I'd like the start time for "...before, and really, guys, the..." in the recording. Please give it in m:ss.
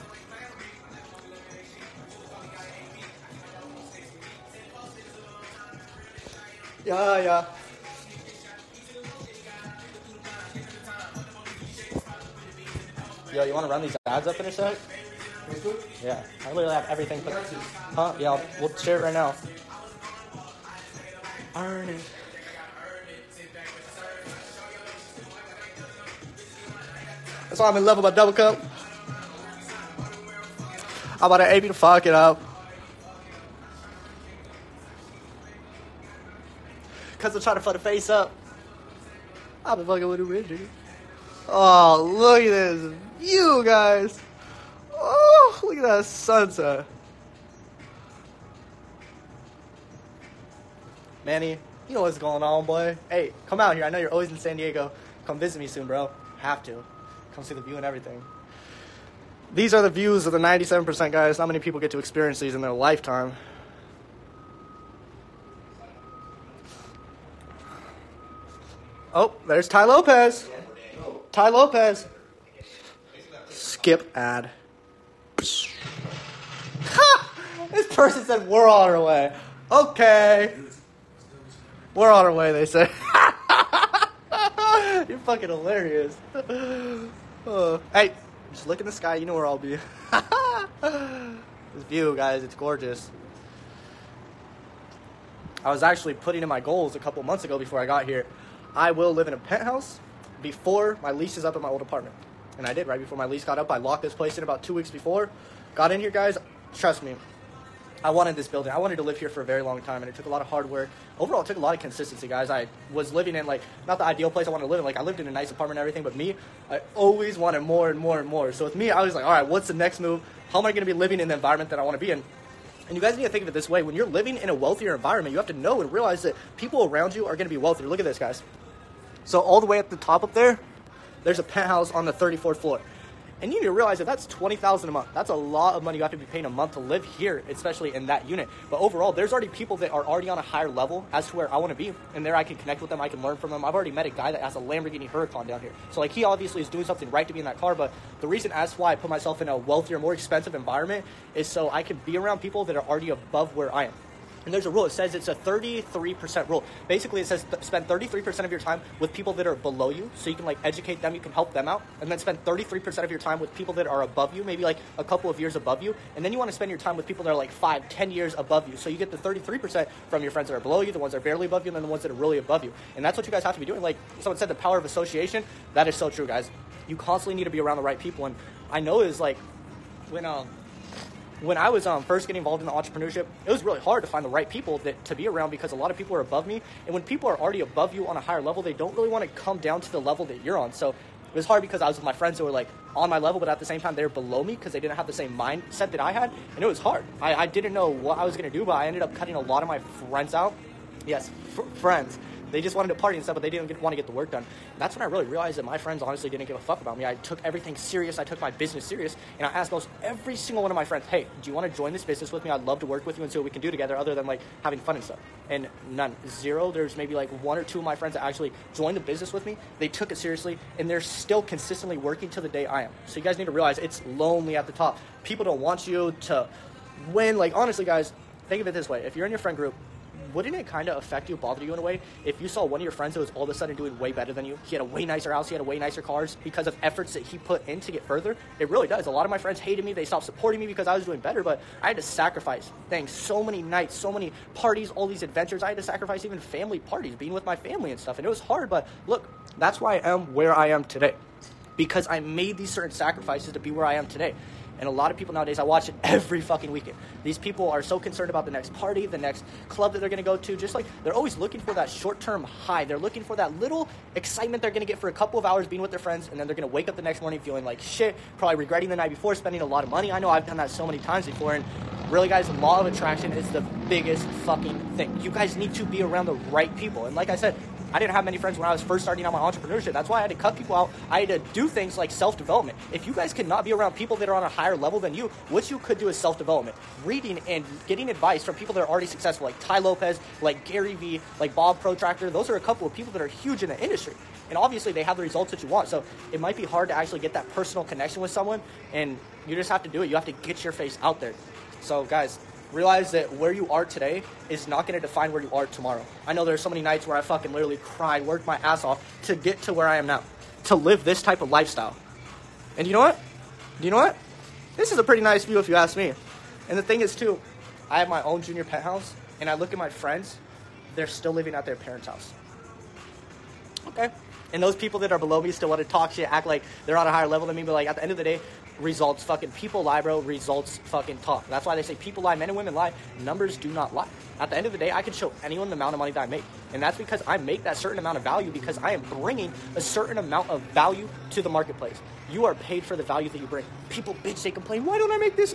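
4:31.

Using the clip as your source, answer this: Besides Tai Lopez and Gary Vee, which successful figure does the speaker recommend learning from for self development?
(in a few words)
Bob Proctor.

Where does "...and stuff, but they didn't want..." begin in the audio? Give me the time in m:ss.
3:23.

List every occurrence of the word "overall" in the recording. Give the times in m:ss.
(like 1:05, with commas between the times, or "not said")
1:51, 2:18.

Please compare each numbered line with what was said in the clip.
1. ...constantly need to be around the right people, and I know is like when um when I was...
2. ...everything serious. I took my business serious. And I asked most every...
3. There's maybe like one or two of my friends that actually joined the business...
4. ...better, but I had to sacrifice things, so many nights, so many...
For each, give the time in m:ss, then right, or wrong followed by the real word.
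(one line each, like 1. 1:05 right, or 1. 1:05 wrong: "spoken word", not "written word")
1. 2:56 right
2. 3:27 right
3. 3:36 right
4. 4:01 right.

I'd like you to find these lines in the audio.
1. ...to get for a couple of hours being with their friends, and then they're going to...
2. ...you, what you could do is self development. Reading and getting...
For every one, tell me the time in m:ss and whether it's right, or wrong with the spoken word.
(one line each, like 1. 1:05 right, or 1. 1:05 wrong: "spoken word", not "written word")
1. 4:24 right
2. 4:45 right.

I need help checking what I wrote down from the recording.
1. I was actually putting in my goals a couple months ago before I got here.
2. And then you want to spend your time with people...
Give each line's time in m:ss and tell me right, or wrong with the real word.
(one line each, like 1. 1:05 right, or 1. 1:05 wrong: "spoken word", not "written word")
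1. 1:35 right
2. 2:46 right.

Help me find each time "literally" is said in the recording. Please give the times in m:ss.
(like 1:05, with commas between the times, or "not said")
0:16, 5:07.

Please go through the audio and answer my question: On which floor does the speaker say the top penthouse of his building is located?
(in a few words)
34th.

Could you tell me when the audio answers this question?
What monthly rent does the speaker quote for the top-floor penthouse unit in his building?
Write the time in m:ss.
2:14.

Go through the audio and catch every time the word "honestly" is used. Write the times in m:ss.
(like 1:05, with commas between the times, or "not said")
3:26, 3:47.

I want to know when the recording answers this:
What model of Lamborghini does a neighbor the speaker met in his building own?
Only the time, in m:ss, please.
2:25.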